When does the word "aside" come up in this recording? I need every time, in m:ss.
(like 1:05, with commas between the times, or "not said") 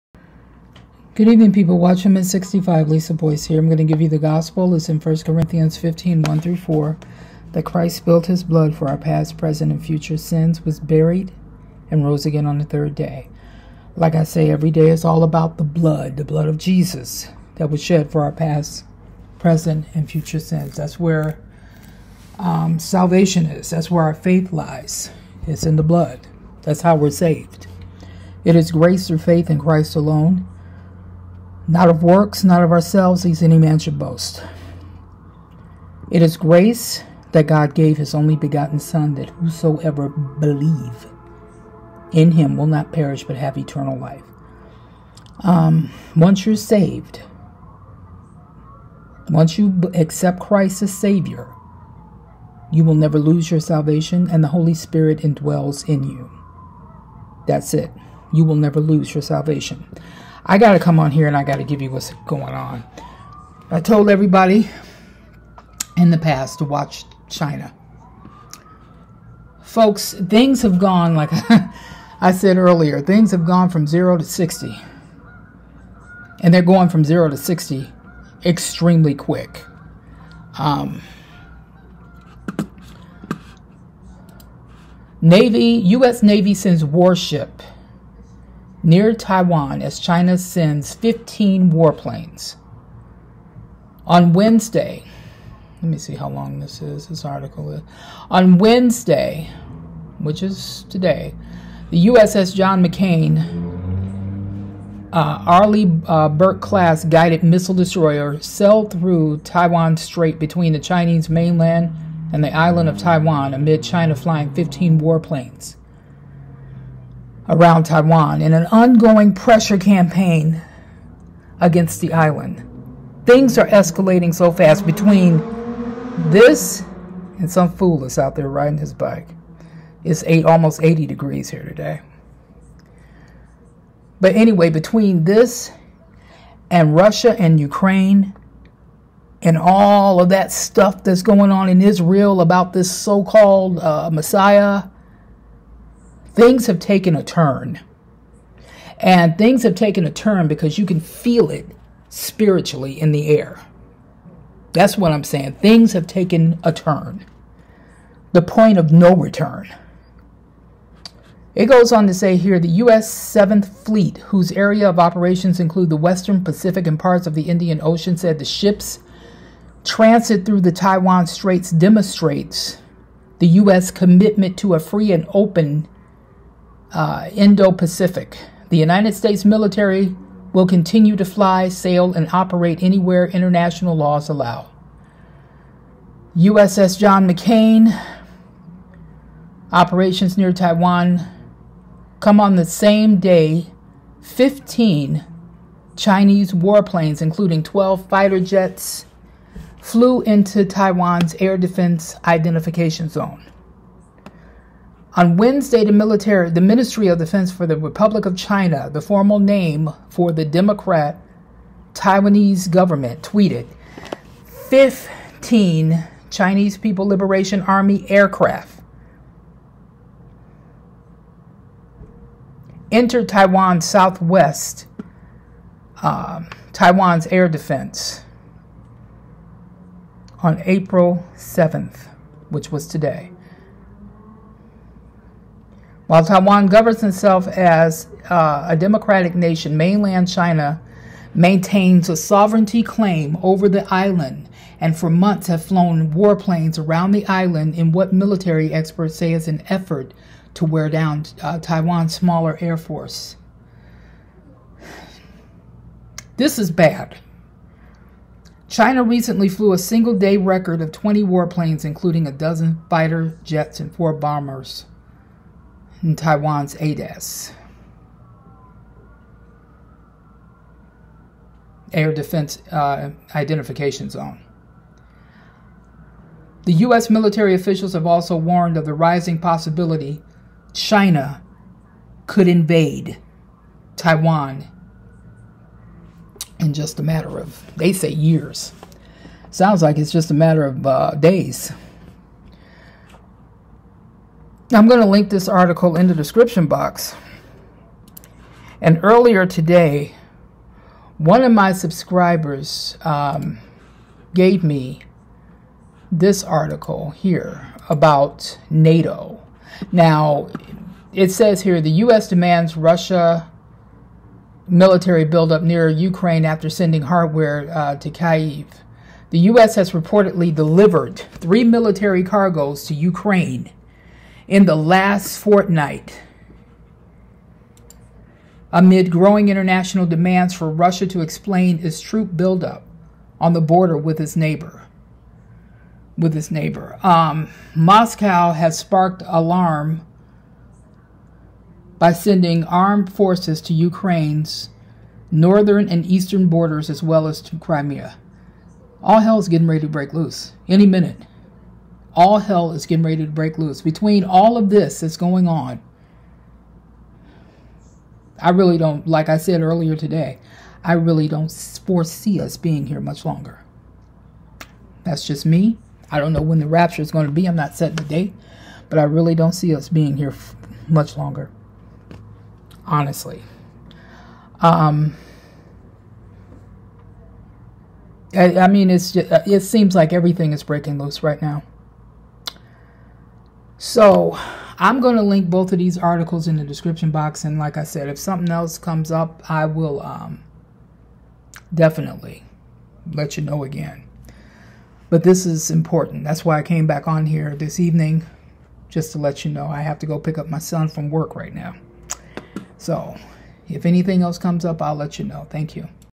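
not said.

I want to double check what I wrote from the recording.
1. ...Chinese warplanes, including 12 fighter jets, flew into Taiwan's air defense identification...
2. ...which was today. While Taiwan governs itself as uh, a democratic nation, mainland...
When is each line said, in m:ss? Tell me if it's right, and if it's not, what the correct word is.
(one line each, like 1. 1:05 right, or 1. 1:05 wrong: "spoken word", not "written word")
1. 3:15 right
2. 3:52 right.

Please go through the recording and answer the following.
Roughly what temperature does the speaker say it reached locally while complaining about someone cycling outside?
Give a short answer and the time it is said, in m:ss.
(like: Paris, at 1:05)
80 degrees, at 2:10.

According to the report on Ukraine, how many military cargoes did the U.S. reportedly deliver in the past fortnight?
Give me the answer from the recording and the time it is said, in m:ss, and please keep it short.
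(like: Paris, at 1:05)
3, at 5:21.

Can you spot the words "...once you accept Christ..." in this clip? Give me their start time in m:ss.
0:49.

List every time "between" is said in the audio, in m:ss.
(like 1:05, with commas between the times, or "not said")
1:50, 2:04, 2:14, 5:53.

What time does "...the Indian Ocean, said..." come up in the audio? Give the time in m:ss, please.
2:47.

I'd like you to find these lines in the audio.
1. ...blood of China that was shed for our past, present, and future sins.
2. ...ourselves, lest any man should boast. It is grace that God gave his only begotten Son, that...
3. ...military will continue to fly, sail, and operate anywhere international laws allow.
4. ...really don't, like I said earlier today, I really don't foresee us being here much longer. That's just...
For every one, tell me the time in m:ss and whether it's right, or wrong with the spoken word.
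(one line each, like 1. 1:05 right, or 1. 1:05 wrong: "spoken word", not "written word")
1. 0:16 wrong: "Jesus", not "China"
2. 0:32 right
3. 2:59 right
4. 5:58 right.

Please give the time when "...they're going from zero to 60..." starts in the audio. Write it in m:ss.
1:16.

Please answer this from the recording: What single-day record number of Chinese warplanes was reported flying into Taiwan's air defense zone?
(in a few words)
20.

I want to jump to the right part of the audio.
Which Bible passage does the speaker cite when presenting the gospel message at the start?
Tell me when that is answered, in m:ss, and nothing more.
0:04.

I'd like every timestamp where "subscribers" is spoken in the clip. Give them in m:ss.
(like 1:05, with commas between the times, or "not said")
5:01.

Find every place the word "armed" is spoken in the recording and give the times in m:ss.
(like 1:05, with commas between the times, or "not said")
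5:42.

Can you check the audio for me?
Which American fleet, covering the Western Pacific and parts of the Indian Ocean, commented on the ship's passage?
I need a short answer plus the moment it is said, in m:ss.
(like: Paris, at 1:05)
U.S. 7th Fleet, at 2:42.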